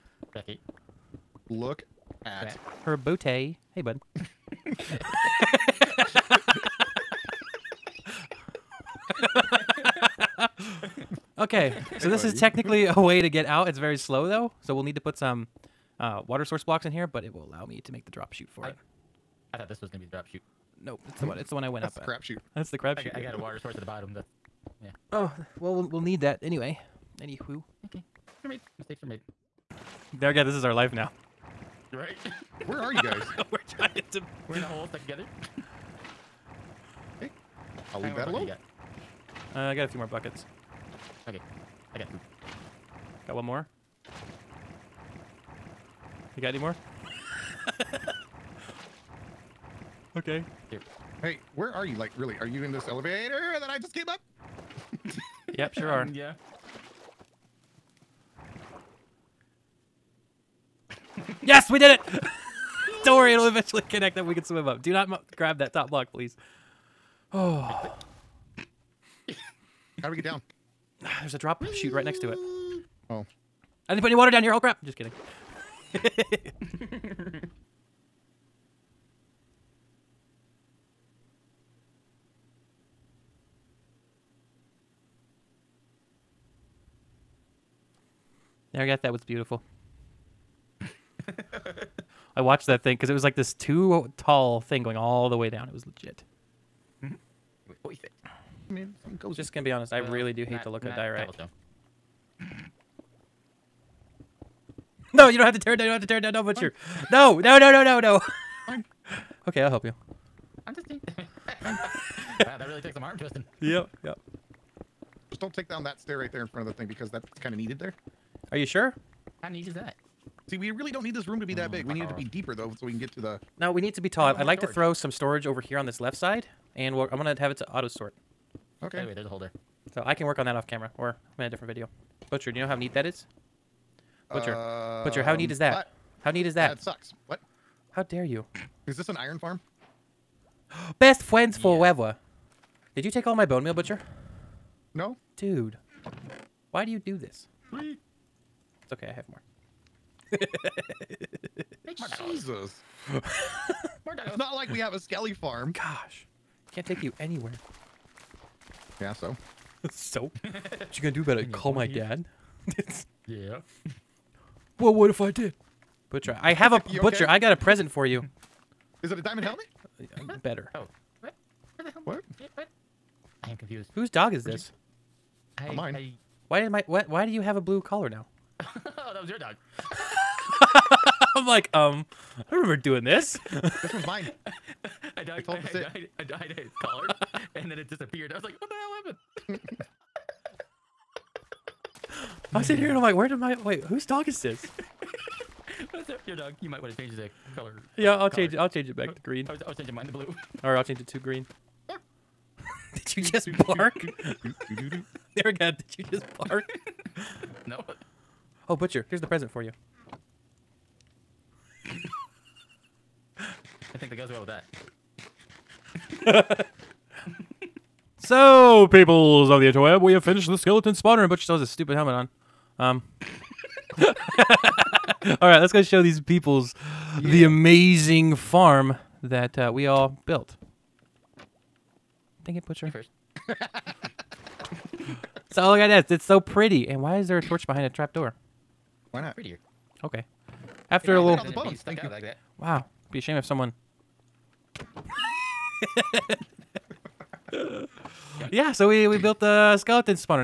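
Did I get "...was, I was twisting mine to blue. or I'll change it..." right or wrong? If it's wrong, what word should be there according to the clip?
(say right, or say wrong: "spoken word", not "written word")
wrong: "changing", not "twisting".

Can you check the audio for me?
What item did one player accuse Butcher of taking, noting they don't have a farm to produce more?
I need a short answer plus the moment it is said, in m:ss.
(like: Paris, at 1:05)
bone meal, at 2:23.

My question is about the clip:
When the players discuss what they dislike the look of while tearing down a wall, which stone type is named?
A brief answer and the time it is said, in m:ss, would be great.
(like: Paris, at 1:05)
diorite, at 1:40.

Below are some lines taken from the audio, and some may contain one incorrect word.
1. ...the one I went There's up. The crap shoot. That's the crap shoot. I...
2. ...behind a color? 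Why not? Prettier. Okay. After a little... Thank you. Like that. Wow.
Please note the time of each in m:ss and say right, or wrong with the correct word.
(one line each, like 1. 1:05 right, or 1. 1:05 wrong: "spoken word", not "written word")
1. 0:21 wrong: "That", not "There"
2. 3:57 wrong: "trapdoor", not "color".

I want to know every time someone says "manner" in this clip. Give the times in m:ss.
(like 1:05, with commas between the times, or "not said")
not said.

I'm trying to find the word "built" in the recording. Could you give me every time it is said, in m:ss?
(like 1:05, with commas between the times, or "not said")
3:50, 4:09.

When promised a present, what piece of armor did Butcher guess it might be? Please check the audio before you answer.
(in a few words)
diamond helmet.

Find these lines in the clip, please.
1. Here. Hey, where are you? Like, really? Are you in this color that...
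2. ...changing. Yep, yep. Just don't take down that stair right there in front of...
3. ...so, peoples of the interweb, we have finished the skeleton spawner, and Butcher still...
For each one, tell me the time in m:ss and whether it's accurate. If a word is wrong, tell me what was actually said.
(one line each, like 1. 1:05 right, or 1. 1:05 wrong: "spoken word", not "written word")
1. 0:50 wrong: "elevator", not "color"
2. 1:53 wrong: "twisting", not "changing"
3. 3:38 right.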